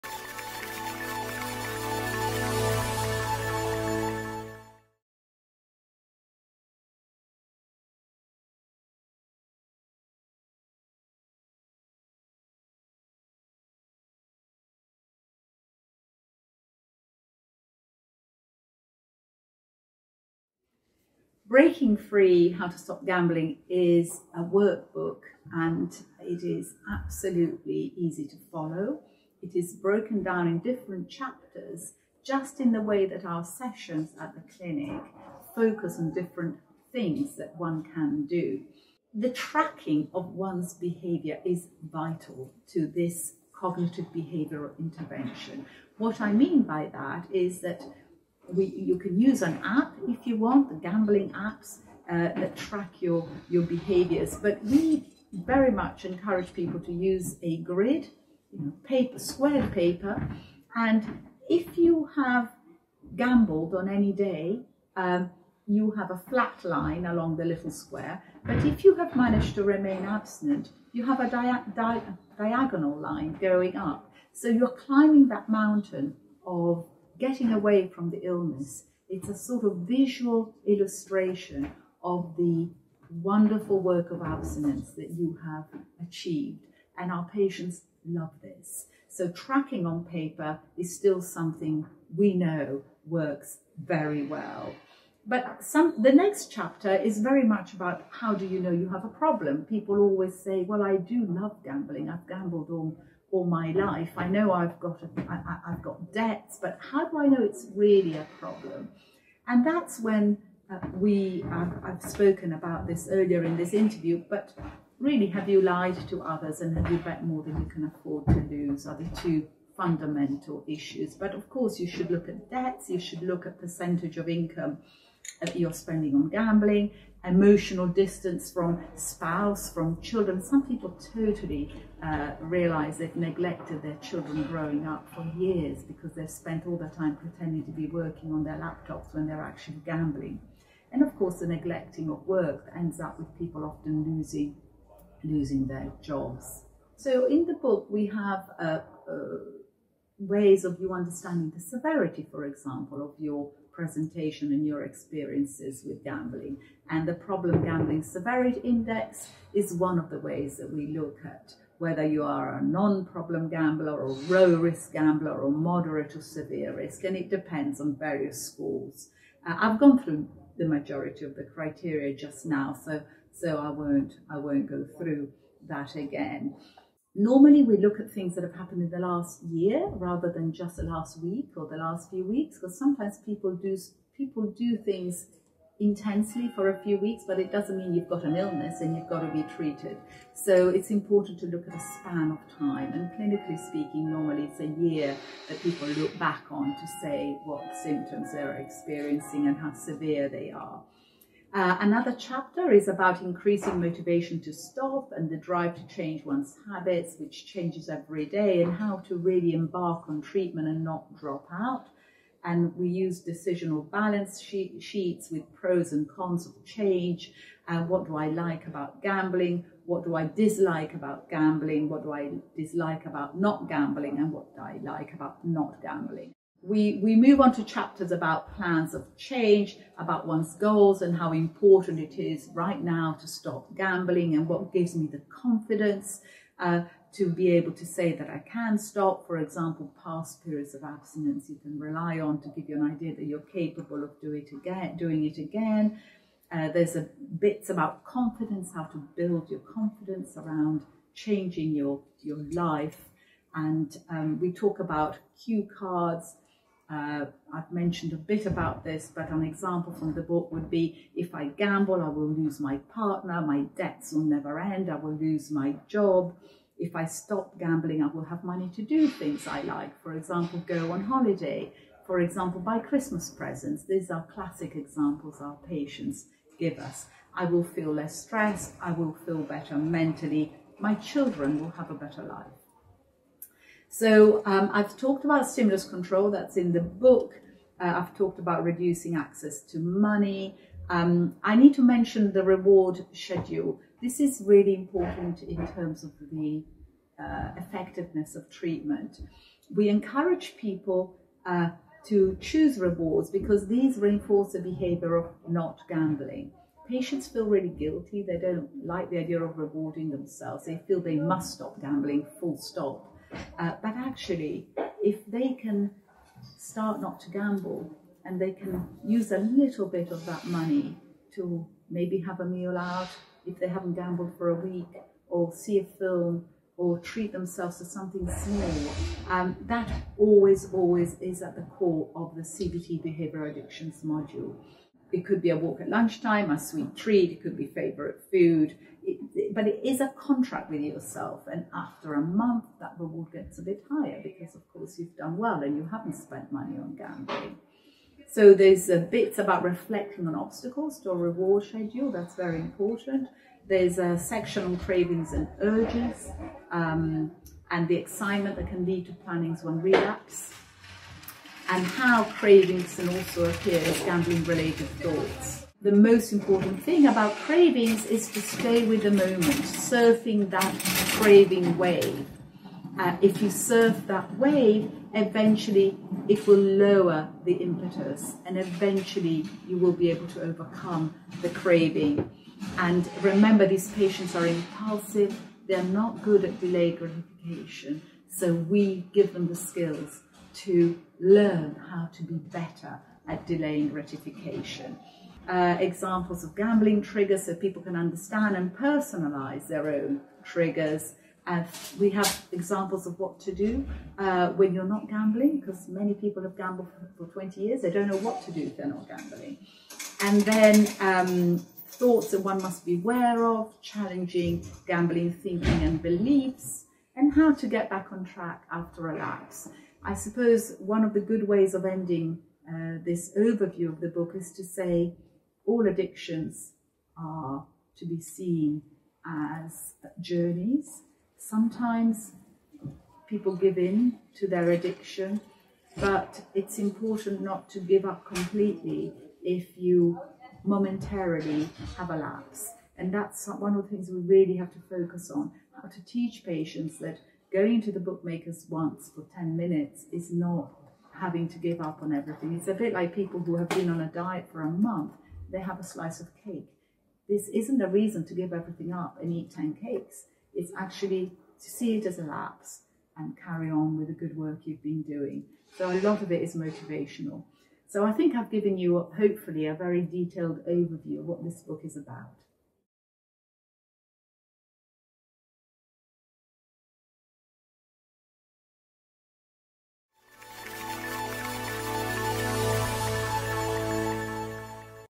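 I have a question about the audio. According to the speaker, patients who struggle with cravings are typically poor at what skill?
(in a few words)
delayed gratification.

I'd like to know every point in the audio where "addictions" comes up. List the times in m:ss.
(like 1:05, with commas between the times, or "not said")
5:33, 7:05, 7:14.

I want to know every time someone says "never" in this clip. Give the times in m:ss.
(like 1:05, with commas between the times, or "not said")
4:24.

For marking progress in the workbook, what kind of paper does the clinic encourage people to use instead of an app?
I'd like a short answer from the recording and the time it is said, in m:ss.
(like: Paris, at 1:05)
squared paper, at 0:59.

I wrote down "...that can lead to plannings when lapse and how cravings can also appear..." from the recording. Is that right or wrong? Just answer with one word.
wrong.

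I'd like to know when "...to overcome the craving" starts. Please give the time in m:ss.
6:20.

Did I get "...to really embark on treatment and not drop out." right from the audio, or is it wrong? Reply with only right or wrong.
right.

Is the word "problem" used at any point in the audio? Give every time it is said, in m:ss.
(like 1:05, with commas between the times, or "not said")
1:39, 1:48, 2:37, 2:42.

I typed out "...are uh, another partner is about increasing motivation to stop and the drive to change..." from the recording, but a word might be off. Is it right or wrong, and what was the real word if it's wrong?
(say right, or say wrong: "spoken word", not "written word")
wrong: "chapter", not "partner".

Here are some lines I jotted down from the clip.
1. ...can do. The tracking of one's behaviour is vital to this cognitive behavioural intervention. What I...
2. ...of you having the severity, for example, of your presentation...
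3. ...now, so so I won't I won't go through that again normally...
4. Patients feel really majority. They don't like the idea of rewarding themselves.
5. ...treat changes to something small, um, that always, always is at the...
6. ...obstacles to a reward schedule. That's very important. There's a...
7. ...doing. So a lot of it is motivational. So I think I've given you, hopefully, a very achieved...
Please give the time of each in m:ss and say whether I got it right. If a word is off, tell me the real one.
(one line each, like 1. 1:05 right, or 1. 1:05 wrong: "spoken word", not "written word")
1. 0:37 right
2. 2:30 wrong: "understanding", not "having"
3. 2:52 right
4. 5:06 wrong: "guilty", not "majority"
5. 5:26 wrong: "themselves", not "changes"
6. 5:50 right
7. 7:45 wrong: "detailed", not "achieved".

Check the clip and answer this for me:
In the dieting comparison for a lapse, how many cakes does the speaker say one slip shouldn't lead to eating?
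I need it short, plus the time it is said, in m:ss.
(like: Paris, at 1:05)
10, at 7:39.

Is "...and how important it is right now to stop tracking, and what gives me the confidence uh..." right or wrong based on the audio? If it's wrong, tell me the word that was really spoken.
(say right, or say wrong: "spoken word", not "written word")
wrong: "gambling", not "tracking".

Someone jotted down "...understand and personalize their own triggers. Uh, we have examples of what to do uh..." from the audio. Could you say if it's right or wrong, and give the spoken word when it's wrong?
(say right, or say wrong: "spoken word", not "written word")
right.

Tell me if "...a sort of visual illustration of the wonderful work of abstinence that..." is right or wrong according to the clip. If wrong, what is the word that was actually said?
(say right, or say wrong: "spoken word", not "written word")
right.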